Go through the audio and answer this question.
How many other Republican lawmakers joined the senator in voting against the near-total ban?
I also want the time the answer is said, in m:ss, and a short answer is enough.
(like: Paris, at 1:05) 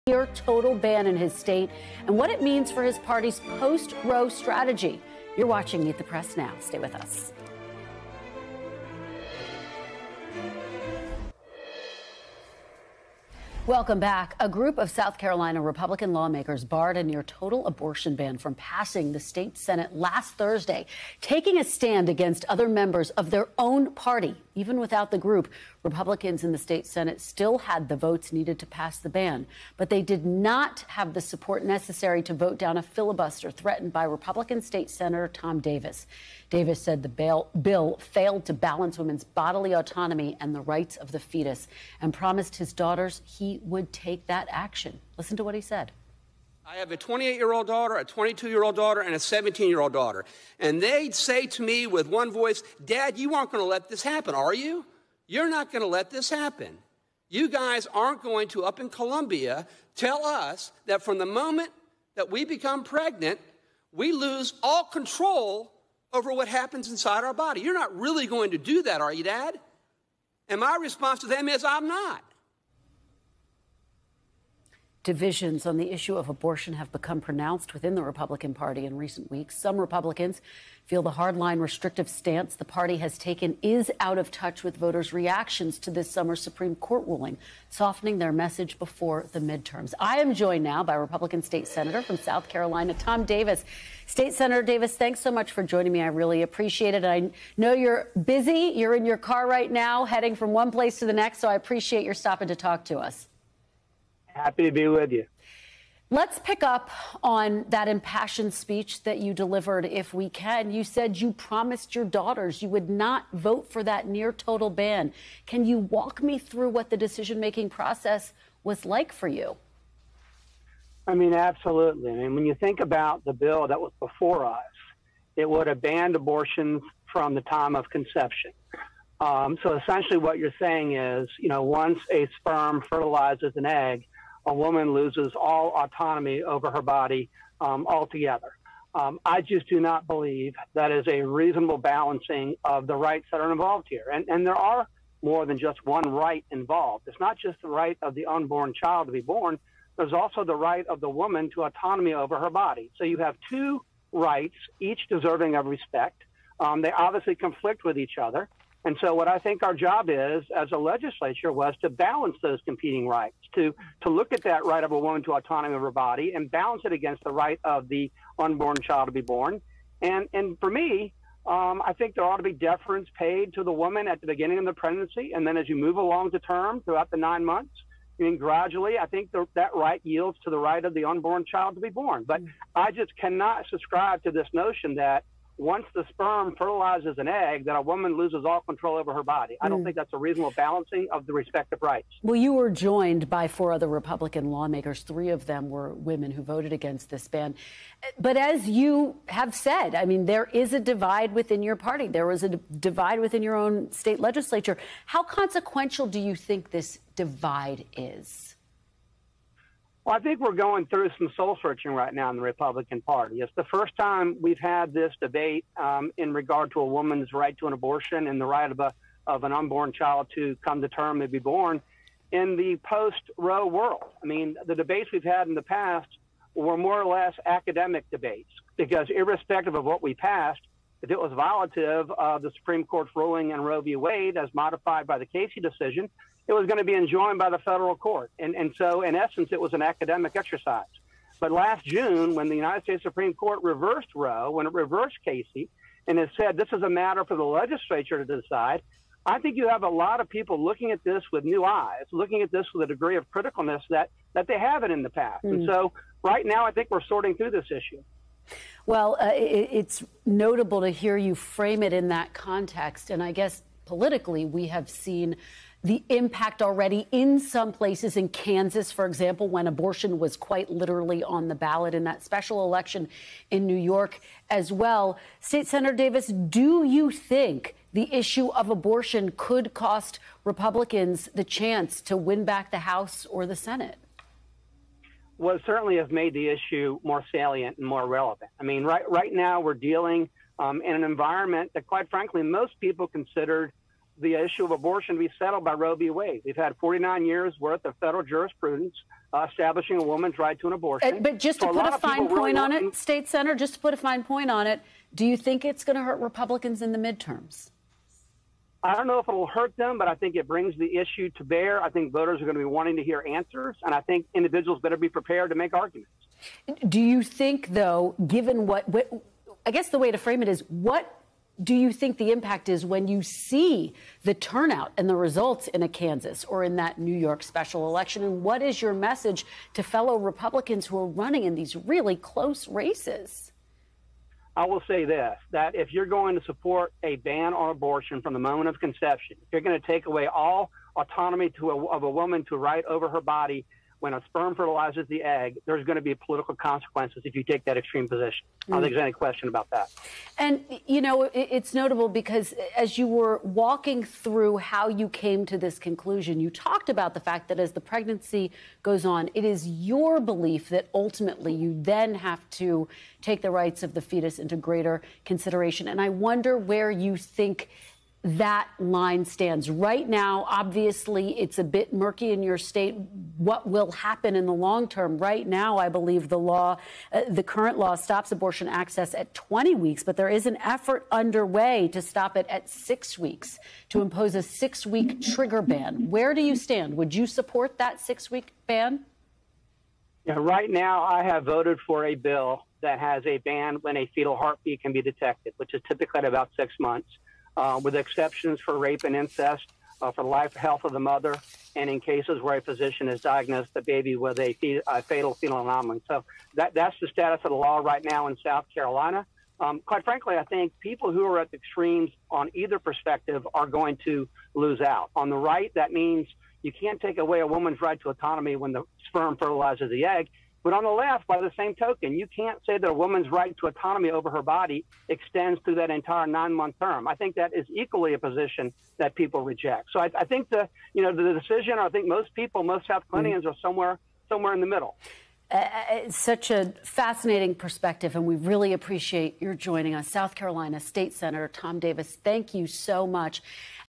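4, at 3:13.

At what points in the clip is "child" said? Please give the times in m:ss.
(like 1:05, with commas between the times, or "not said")
2:28, 2:48, 3:01, 3:39.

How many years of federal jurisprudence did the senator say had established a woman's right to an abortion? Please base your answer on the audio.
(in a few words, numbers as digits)
49.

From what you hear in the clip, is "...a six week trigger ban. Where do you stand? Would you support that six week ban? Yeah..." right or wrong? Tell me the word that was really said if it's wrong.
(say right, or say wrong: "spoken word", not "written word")
right.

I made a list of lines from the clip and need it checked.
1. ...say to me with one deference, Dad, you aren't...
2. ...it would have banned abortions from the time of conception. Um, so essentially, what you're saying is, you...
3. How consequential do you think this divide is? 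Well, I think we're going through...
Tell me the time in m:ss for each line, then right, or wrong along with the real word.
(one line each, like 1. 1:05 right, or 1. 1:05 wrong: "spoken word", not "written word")
1. 0:51 wrong: "voice", not "deference"
2. 2:05 right
3. 3:25 right.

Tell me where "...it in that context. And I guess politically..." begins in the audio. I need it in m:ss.
4:21.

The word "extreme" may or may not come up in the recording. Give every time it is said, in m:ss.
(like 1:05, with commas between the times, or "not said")
5:47, 6:51.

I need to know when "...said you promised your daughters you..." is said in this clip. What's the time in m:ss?
1:50.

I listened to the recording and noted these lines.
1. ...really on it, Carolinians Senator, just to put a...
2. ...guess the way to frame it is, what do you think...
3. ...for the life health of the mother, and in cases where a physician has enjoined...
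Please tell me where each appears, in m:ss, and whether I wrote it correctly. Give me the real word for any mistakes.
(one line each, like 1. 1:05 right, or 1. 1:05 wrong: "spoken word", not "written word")
1. 5:02 wrong: "State", not "Carolinians"
2. 5:19 right
3. 6:40 wrong: "diagnosed", not "enjoined".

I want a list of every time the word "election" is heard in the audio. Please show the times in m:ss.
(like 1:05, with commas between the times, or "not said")
4:32, 5:27.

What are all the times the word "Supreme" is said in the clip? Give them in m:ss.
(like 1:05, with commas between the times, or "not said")
1:26, 3:52, 4:03.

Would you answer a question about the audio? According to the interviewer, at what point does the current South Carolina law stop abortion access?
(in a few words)
20 weeks.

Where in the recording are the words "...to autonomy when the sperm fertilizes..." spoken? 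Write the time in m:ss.
6:58.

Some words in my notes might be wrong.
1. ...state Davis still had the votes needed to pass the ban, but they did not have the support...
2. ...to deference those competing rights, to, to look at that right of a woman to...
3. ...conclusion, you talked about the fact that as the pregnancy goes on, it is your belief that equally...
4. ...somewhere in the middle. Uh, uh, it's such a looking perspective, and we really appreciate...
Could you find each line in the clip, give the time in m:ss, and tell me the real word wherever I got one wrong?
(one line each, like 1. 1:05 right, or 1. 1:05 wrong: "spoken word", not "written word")
1. 0:26 wrong: "Senate", not "Davis"
2. 2:41 wrong: "balance", not "deference"
3. 5:55 wrong: "ultimately", not "equally"
4. 7:14 wrong: "fascinating", not "looking".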